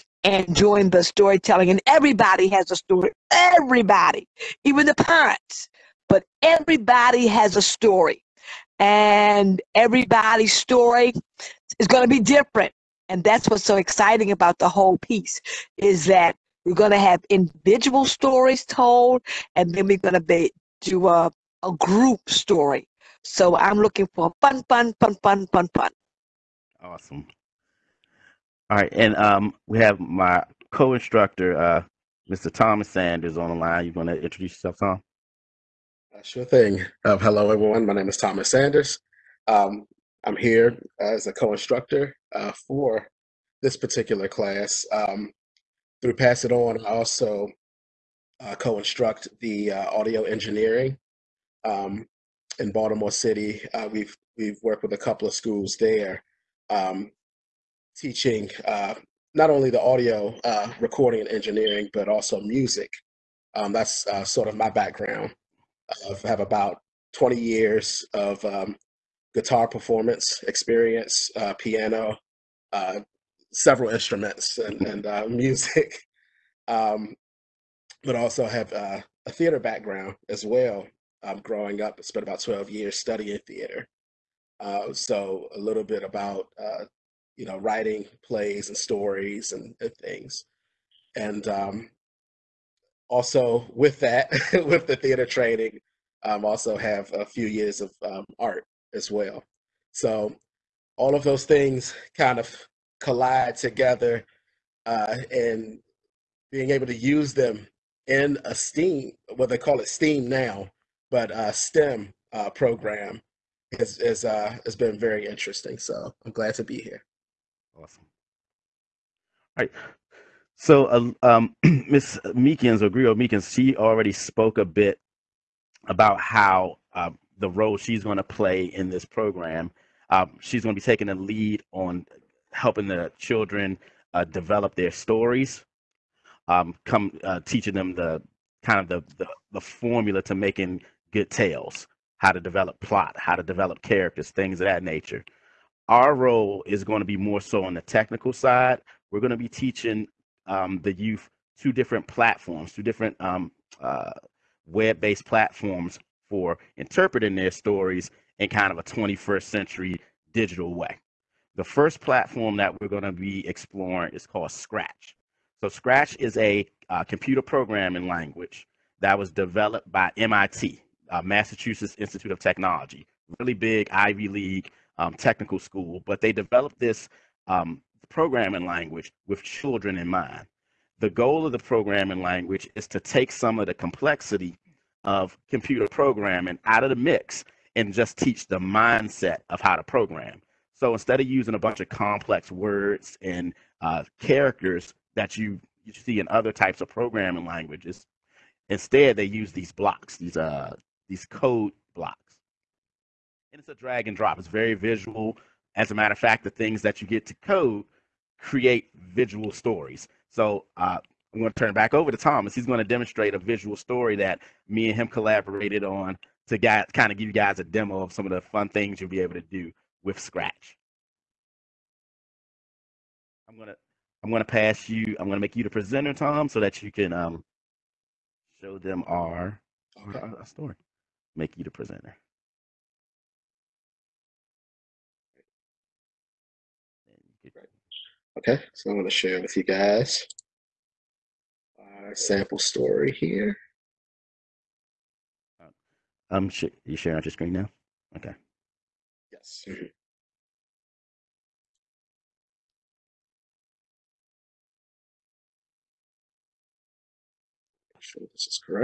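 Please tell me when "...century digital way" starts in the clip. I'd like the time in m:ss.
2:39.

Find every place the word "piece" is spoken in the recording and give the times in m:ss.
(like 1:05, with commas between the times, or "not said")
0:14.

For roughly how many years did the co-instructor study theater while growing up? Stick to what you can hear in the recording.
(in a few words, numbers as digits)
12.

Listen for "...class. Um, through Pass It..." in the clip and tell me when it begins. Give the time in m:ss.
0:44.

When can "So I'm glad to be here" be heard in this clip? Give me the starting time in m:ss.
1:55.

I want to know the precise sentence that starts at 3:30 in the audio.
So uh, I'm going to turn back over to Thomas.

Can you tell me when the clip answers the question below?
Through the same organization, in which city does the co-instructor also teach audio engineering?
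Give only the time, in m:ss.
0:52.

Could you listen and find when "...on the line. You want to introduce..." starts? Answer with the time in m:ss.
0:33.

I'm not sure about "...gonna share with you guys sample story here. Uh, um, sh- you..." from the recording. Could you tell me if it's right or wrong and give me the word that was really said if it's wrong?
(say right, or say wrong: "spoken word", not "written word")
right.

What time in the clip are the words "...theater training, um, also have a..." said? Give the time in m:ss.
1:34.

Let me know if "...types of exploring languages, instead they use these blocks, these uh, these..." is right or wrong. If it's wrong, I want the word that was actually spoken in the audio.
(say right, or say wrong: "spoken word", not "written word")
wrong: "programming", not "exploring".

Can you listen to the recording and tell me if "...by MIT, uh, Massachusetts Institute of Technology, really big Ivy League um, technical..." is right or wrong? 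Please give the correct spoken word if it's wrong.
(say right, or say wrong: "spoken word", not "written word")
right.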